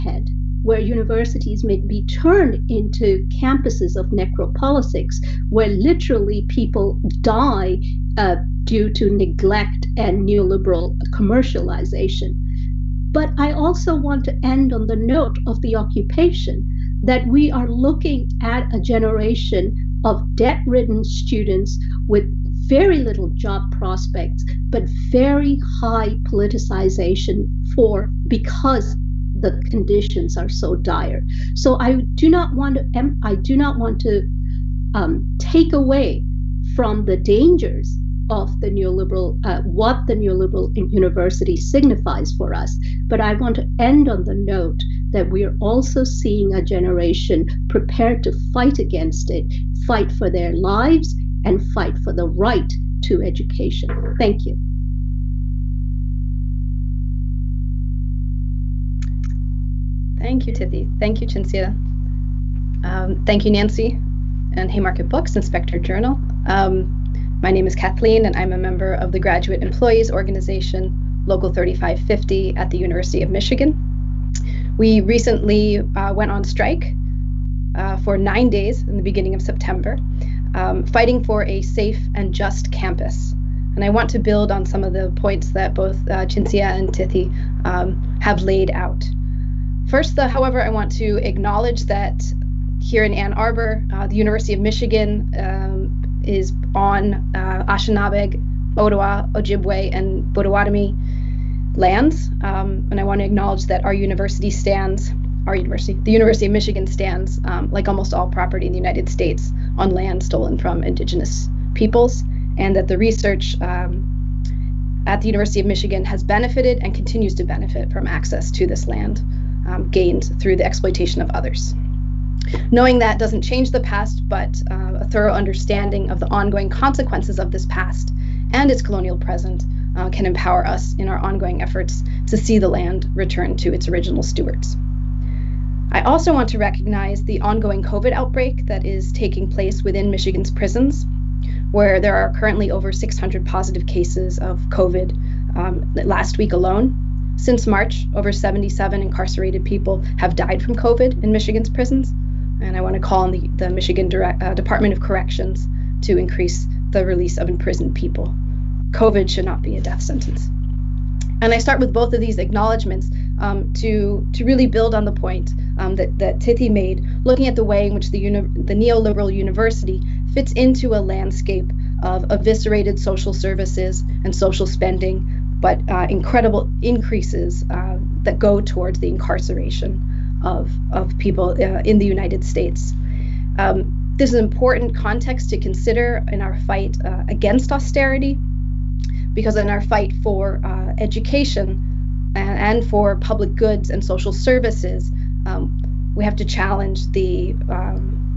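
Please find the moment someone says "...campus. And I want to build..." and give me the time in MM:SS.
01:22.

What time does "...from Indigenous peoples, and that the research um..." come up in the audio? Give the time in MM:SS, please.
01:50.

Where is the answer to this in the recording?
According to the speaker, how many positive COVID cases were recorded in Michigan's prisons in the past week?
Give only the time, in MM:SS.
02:22.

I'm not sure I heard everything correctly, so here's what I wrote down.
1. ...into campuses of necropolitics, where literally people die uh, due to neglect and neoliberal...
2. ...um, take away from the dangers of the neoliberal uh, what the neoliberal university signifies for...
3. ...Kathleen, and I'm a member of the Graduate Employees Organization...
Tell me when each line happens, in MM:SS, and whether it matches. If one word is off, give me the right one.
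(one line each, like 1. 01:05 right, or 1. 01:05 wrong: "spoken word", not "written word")
1. 00:02 right
2. 00:34 right
3. 01:07 right.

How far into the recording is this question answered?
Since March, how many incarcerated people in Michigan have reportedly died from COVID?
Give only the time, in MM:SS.
02:28.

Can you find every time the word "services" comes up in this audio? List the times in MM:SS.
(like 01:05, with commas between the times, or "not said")
02:53, 03:14.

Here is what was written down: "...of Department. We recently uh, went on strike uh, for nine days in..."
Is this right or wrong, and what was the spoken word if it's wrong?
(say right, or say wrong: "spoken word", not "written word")
wrong: "Michigan", not "Department".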